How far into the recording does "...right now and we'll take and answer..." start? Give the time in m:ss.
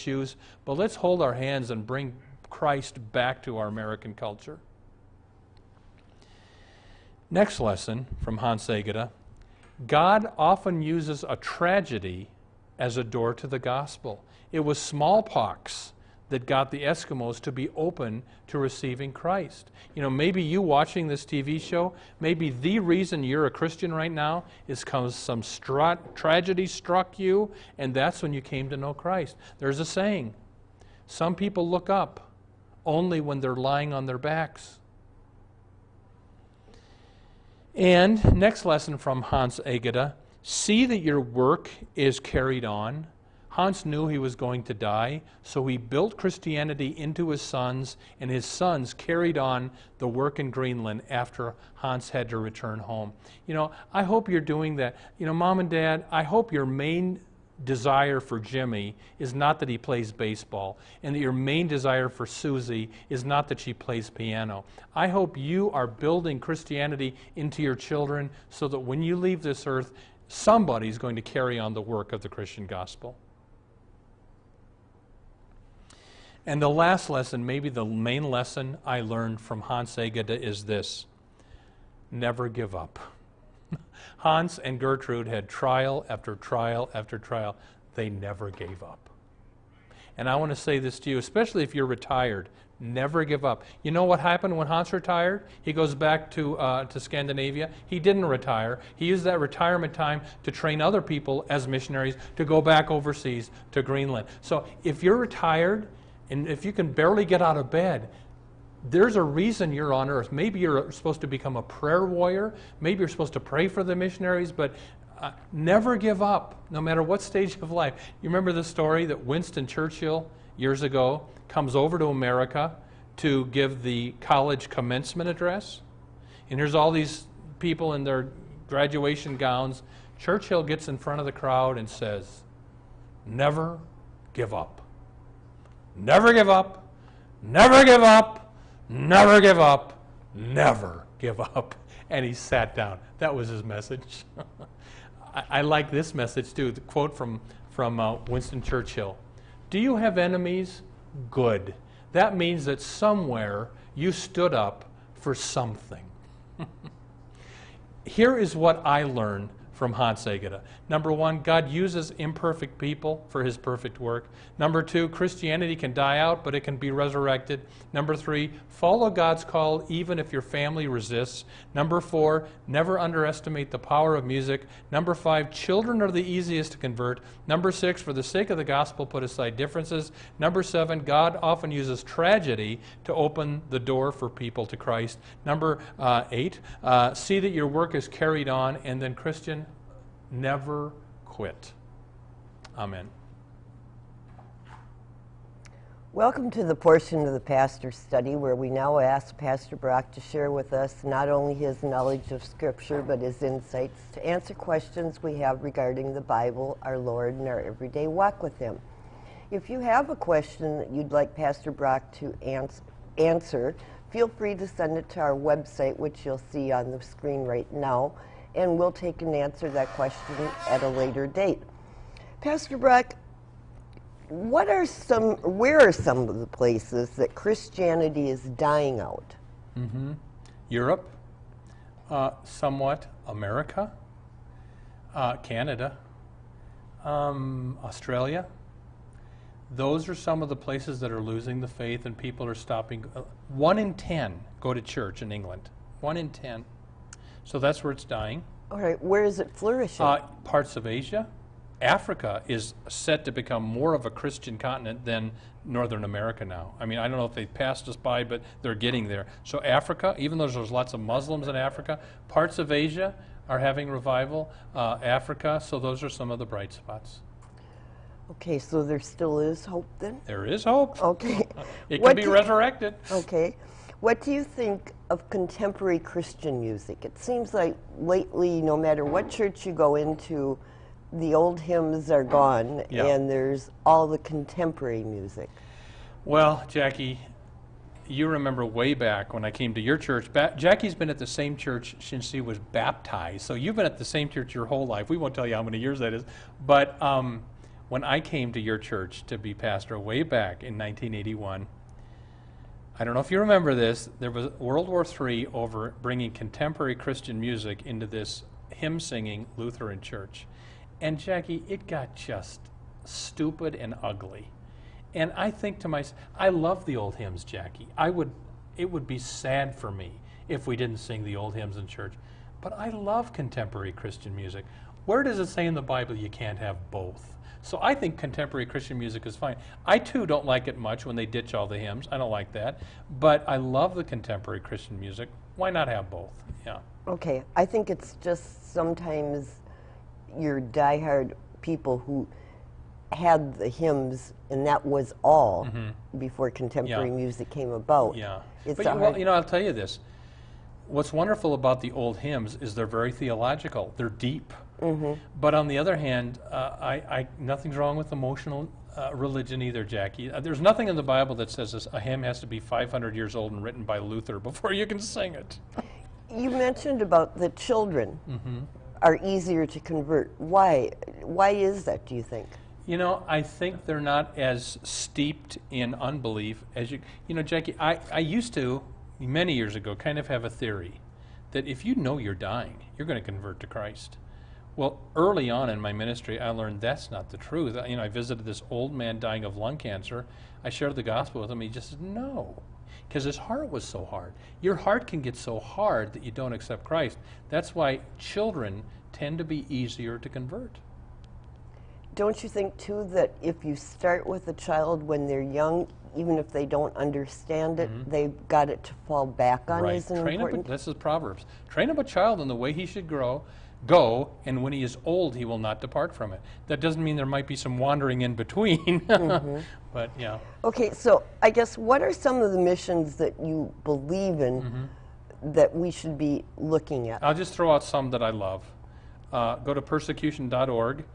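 3:37.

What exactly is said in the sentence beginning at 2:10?
Churchill gets in front of the crowd and says, Never give up.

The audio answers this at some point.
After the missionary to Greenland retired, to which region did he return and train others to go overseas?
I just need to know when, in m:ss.
1:36.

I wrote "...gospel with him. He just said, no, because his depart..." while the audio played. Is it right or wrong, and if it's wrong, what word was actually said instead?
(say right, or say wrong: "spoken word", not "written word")
wrong: "heart", not "depart".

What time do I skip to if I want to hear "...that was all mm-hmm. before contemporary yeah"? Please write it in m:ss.
5:44.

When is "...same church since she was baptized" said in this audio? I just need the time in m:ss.
4:51.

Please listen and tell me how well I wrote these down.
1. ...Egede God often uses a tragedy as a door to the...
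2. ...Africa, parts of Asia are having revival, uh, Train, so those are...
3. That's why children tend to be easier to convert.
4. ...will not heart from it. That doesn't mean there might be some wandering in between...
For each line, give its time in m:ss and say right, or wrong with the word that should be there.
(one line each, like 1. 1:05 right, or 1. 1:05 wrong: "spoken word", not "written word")
1. 0:08 right
2. 4:21 wrong: "Africa", not "Train"
3. 6:37 right
4. 6:55 wrong: "depart", not "heart".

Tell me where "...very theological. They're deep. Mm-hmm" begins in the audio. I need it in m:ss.
5:52.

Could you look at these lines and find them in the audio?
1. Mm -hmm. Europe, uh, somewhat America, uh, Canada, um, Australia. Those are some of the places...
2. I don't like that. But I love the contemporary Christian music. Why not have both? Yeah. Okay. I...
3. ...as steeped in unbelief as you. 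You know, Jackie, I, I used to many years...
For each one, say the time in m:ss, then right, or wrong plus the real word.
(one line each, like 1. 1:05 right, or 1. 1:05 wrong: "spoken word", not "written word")
1. 3:49 right
2. 5:32 right
3. 6:14 right.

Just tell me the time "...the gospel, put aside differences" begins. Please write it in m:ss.
2:58.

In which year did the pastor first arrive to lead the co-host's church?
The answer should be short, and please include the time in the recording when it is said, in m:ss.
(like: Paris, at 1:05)
1981, at 5:00.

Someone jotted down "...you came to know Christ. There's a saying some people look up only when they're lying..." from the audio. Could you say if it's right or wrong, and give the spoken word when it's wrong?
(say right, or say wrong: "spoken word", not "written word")
right.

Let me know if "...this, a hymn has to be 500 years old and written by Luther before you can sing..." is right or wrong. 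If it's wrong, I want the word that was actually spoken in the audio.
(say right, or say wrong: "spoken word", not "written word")
right.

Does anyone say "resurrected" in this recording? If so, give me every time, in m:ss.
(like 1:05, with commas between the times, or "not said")
2:46, 4:32.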